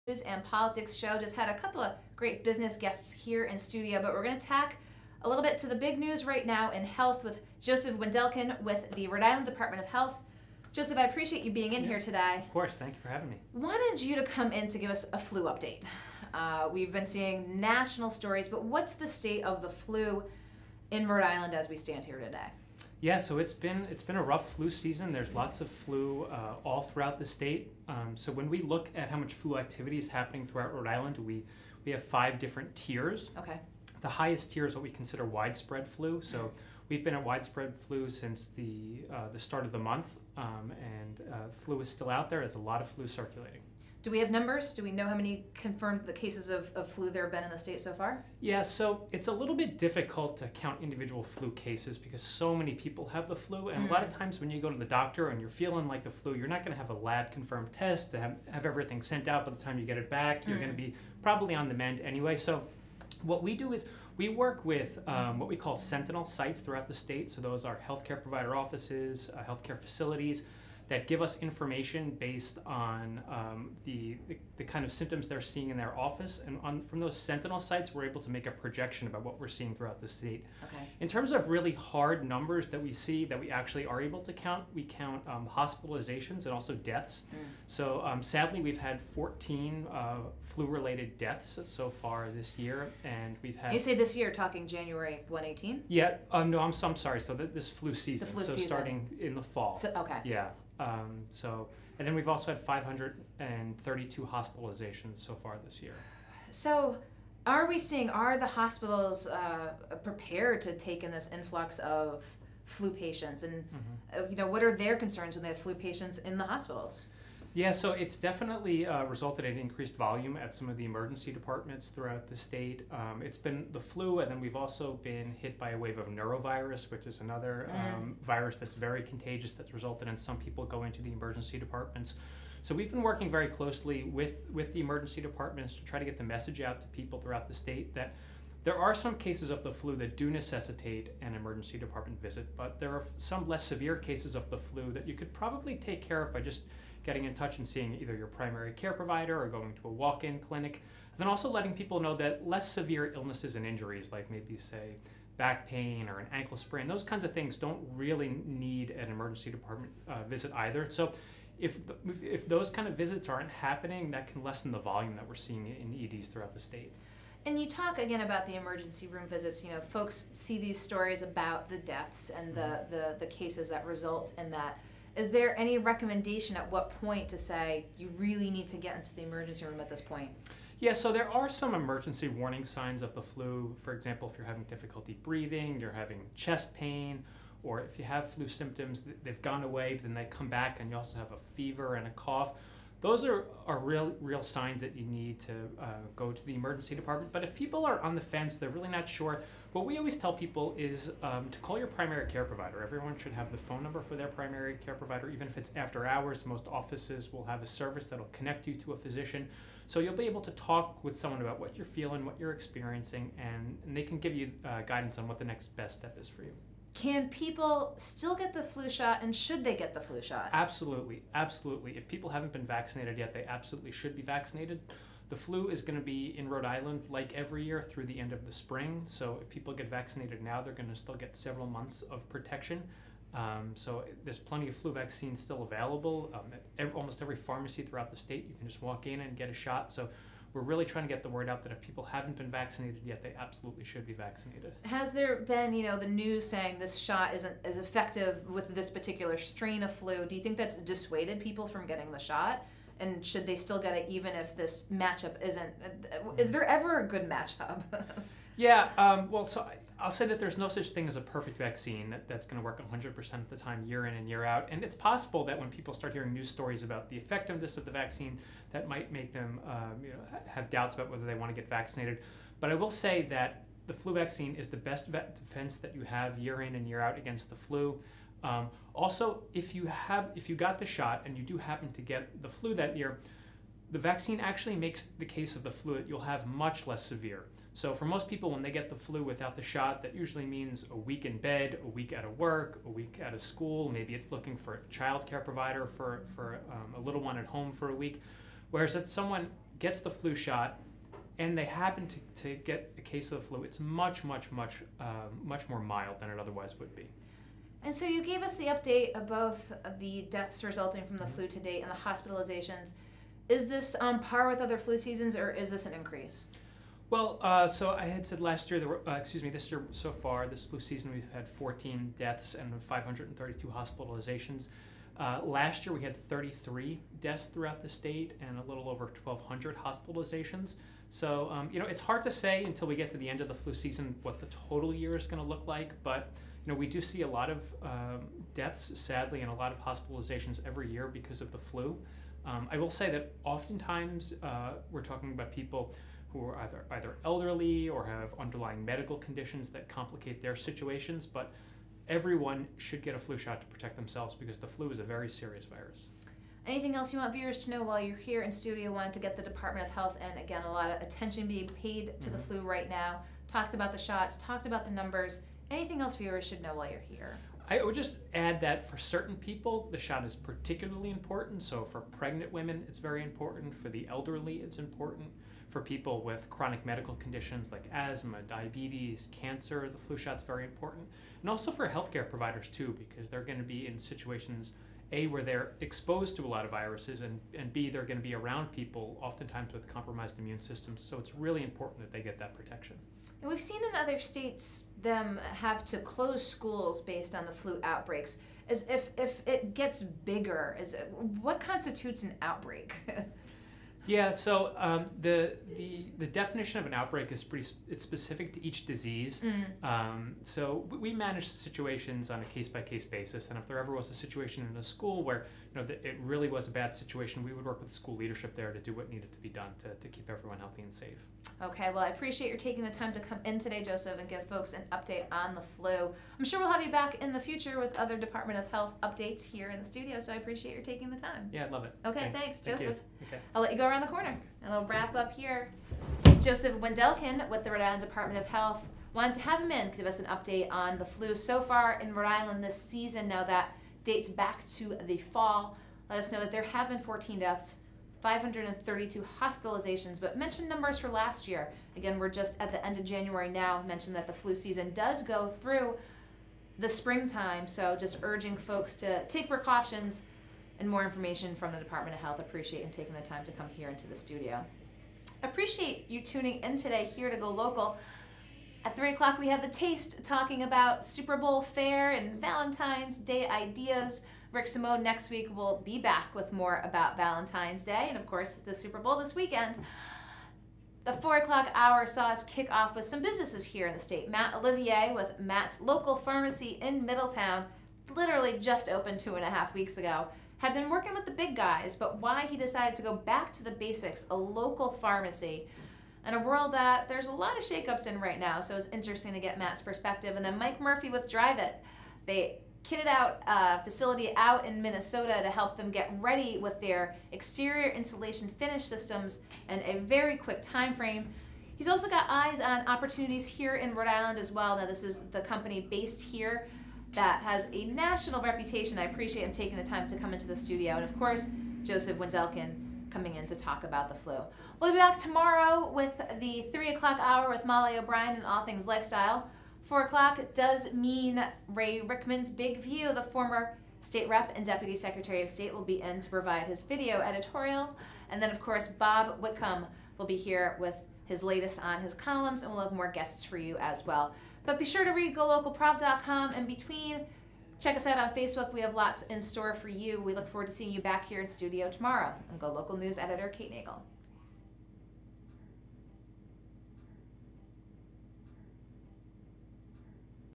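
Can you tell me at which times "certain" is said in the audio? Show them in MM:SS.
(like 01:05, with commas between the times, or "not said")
06:08.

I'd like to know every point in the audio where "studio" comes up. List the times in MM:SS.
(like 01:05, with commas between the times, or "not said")
00:03, 05:58, 07:09, 07:44, 08:40, 09:11.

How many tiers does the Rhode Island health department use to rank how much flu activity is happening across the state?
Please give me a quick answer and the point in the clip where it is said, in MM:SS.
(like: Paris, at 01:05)
5, at 00:32.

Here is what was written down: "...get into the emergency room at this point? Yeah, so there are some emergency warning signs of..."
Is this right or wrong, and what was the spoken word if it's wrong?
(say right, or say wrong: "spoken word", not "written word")
right.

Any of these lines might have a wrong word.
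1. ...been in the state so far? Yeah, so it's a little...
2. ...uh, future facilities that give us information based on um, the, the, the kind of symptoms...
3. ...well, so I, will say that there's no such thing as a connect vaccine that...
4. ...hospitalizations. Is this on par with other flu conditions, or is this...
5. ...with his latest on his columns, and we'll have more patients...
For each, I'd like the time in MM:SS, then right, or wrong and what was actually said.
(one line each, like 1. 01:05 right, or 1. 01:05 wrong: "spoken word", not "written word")
1. 00:47 right
2. 01:09 wrong: "healthcare", not "future"
3. 04:19 wrong: "perfect", not "connect"
4. 05:11 wrong: "seasons", not "conditions"
5. 09:00 wrong: "guests", not "patients".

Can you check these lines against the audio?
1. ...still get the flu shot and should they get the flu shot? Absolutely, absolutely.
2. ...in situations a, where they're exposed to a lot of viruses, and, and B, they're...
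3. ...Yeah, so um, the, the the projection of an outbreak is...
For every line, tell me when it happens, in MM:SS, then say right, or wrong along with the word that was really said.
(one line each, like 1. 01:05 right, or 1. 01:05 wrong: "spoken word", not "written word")
1. 03:37 right
2. 06:23 right
3. 06:44 wrong: "definition", not "projection".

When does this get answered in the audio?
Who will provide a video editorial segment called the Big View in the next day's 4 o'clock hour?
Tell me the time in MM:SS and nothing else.
08:51.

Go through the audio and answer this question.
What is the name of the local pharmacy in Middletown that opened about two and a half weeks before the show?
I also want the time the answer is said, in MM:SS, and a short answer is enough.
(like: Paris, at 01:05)
Matt's Local Pharmacy, at 08:05.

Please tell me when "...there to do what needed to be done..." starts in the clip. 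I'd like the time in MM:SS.
06:58.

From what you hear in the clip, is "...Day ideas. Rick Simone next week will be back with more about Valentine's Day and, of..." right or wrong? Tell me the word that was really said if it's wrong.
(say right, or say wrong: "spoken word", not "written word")
right.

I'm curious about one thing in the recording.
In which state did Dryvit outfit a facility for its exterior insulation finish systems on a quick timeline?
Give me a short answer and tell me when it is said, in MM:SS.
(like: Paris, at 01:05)
Minnesota, at 08:24.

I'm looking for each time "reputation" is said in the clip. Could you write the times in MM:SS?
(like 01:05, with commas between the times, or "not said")
08:38.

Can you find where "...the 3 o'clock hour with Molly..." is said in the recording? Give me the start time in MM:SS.
08:46.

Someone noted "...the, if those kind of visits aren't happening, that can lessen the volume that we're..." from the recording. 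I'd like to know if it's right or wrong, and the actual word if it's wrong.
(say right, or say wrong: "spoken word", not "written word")
right.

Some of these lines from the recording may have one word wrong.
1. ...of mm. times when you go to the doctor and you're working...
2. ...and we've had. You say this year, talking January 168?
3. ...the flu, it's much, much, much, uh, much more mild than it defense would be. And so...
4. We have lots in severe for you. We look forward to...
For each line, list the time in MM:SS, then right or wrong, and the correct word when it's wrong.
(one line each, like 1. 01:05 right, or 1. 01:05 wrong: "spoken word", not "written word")
1. 00:54 wrong: "feeling", not "working"
2. 01:33 wrong: "118", not "168"
3. 05:03 wrong: "otherwise", not "defense"
4. 09:08 wrong: "store", not "severe".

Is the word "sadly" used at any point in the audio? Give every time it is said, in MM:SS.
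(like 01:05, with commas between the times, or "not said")
01:28, 05:38.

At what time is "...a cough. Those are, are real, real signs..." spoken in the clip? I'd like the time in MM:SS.
03:12.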